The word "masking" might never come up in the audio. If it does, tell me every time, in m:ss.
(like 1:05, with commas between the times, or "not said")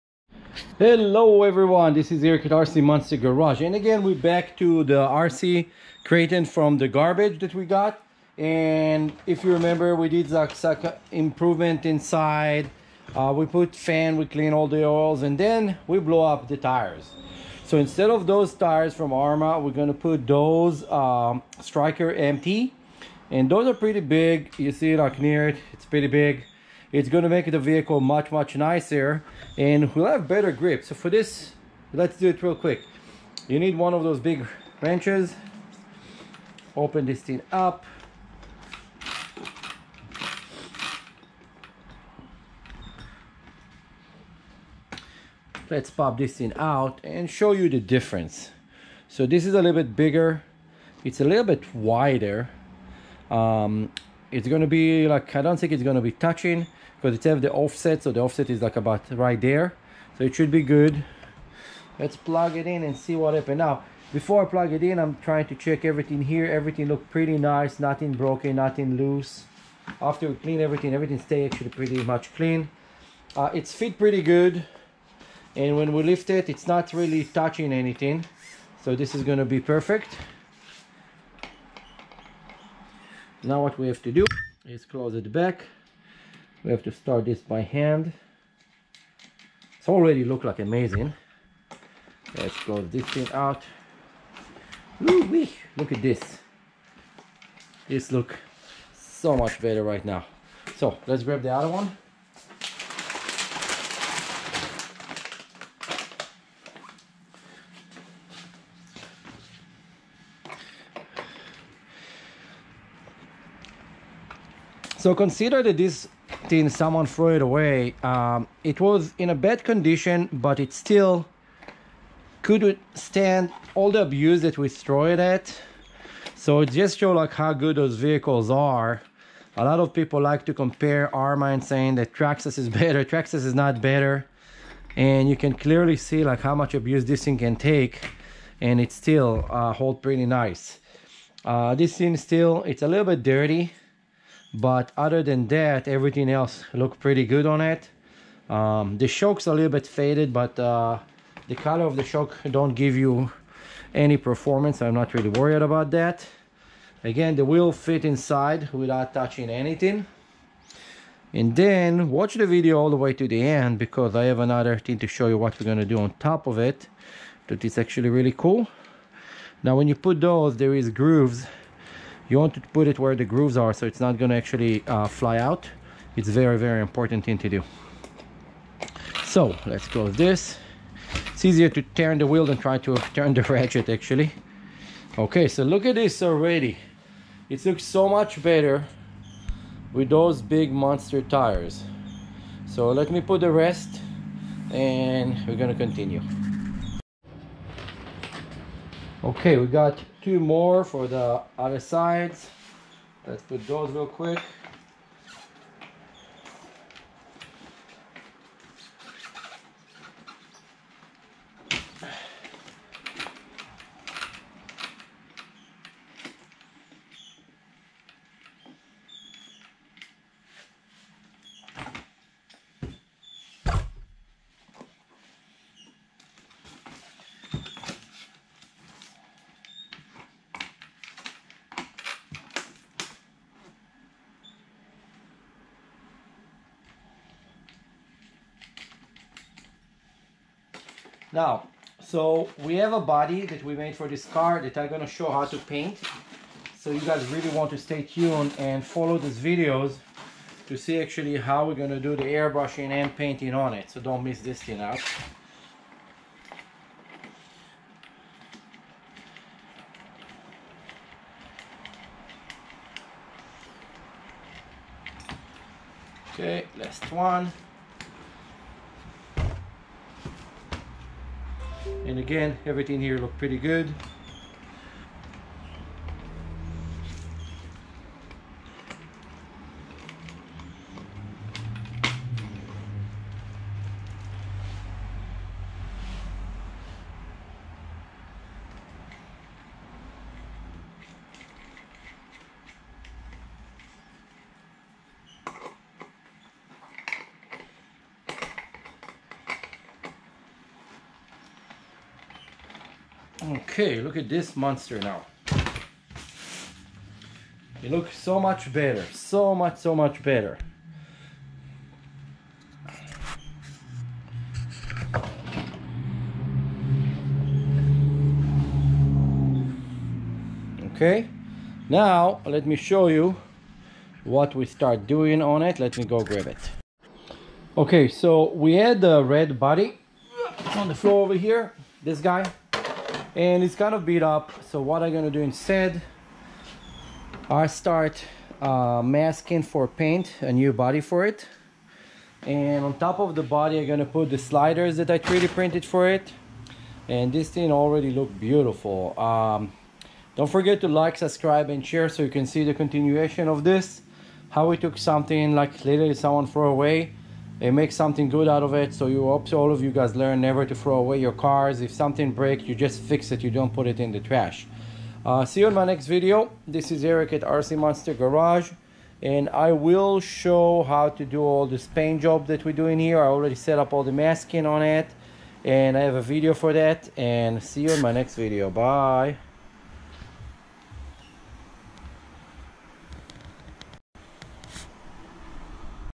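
5:39, 6:14.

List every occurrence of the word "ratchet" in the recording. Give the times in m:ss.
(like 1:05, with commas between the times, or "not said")
3:03.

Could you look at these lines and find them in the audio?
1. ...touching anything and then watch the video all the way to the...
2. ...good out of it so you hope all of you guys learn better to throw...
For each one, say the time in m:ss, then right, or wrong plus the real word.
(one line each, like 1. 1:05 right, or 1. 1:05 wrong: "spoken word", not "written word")
1. 2:39 right
2. 5:58 wrong: "never", not "better".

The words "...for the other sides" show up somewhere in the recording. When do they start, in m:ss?
3:20.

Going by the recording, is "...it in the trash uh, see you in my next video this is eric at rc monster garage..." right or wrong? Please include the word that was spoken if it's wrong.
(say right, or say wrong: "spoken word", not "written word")
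right.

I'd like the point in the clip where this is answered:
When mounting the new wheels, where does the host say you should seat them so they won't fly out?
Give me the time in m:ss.
2:52.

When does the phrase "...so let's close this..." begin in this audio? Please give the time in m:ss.
2:59.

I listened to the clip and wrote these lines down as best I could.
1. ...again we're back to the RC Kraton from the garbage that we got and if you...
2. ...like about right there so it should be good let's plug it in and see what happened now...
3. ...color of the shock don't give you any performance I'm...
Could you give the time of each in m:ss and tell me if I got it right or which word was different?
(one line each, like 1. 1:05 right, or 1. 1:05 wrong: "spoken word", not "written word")
1. 0:03 right
2. 0:58 right
3. 2:31 right.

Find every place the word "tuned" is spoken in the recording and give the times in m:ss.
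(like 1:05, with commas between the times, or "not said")
4:08.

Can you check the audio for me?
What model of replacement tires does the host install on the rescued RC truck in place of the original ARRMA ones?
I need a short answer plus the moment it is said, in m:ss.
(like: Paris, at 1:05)
Striker MT, at 0:21.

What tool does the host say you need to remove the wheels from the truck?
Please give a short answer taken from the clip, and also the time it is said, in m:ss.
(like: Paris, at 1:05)
big wrenches, at 0:34.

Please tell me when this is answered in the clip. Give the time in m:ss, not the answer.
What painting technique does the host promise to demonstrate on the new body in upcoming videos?
4:12.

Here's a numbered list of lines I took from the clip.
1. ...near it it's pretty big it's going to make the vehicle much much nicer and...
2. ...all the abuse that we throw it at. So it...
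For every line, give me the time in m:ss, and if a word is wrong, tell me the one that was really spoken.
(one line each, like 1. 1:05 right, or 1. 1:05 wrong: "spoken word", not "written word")
1. 0:25 right
2. 2:03 right.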